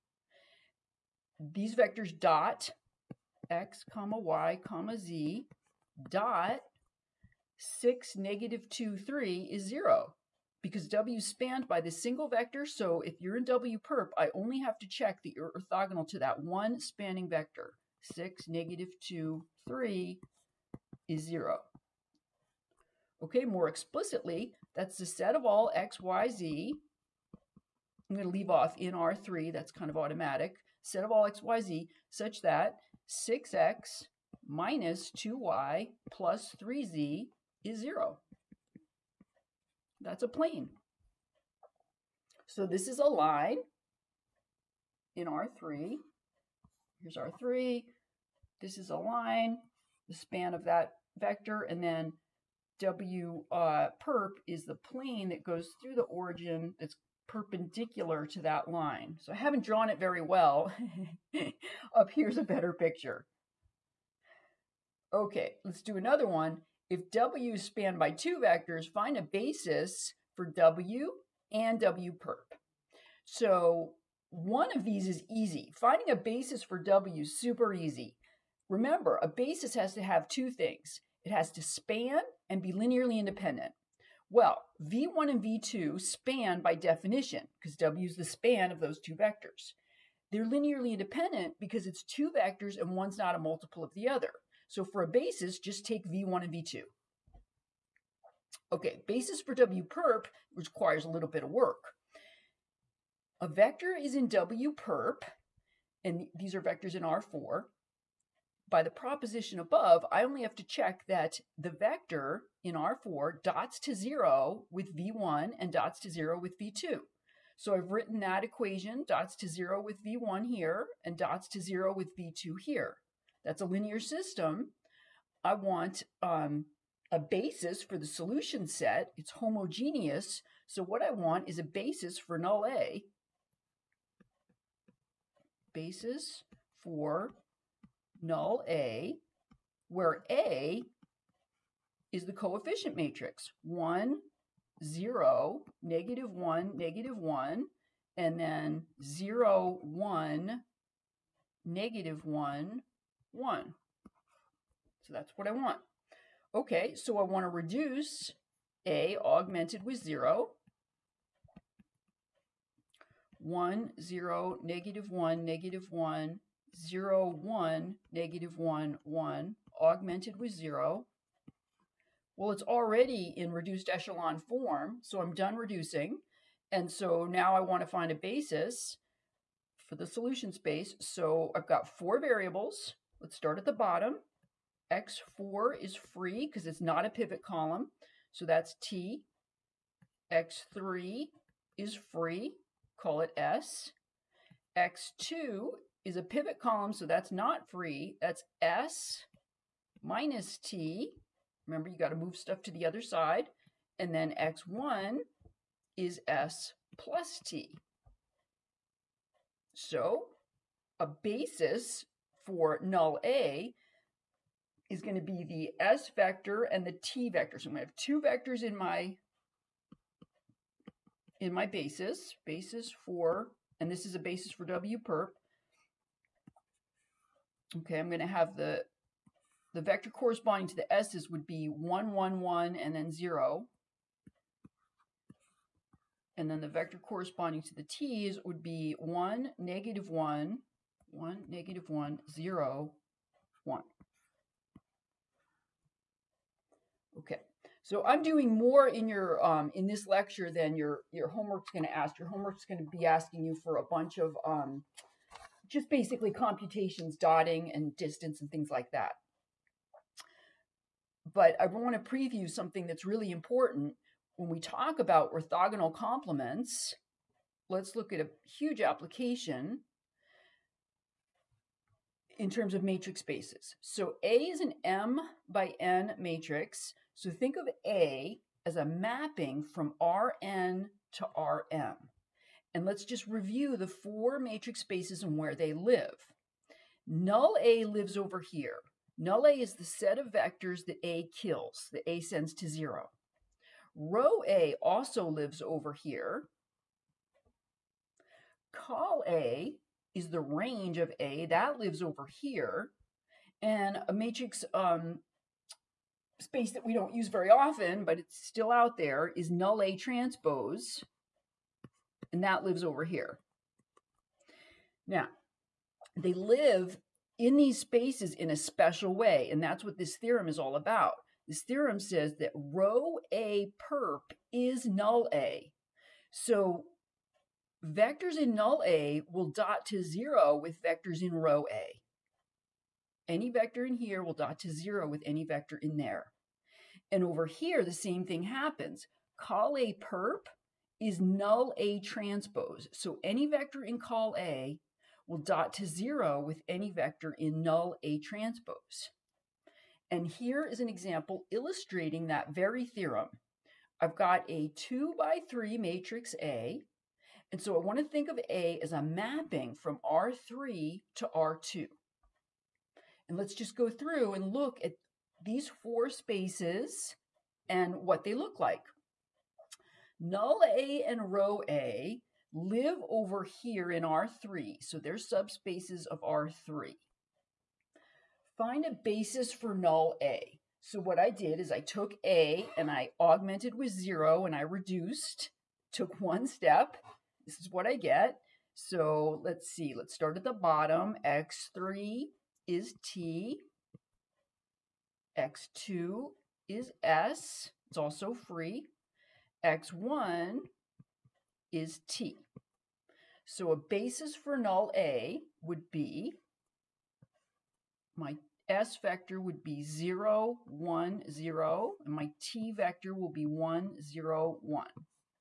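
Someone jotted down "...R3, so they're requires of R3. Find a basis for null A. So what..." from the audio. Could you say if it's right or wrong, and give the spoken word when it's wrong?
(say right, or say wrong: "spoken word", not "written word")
wrong: "subspaces", not "requires".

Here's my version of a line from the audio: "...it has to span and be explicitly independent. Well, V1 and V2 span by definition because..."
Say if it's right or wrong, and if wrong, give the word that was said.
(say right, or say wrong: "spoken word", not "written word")
wrong: "linearly", not "explicitly".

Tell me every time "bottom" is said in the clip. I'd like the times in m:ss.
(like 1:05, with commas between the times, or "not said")
3:03, 6:30.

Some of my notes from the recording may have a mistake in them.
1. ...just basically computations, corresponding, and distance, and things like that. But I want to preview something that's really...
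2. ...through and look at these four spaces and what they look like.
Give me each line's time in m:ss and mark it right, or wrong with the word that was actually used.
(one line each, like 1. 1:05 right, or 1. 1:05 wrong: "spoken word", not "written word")
1. 4:15 wrong: "dotting", not "corresponding"
2. 6:03 right.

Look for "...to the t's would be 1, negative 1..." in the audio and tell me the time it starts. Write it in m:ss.
3:57.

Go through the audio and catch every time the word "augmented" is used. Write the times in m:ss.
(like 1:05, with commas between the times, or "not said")
2:39, 2:49, 6:23.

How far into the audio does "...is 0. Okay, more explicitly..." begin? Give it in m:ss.
0:21.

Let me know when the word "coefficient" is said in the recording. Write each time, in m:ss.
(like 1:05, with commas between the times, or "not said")
2:22.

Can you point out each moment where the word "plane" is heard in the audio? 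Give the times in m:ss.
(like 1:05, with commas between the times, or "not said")
0:40, 0:54.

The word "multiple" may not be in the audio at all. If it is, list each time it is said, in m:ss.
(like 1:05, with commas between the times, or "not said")
1:33.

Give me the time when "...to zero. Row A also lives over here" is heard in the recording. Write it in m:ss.
4:52.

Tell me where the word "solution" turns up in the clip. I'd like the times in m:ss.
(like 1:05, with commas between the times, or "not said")
2:08, 3:00.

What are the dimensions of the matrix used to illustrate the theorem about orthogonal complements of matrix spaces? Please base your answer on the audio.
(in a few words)
2 by 3.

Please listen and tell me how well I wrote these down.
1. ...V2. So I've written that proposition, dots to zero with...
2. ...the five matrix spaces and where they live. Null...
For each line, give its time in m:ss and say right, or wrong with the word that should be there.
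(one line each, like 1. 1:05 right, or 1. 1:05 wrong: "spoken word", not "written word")
1. 1:56 wrong: "equation", not "proposition"
2. 4:43 wrong: "four", not "five".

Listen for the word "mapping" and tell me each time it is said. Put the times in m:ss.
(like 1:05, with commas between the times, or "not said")
4:38, 5:59.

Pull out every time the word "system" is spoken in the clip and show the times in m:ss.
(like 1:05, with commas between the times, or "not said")
2:04.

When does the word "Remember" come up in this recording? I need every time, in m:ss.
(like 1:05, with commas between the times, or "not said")
1:18, 3:21.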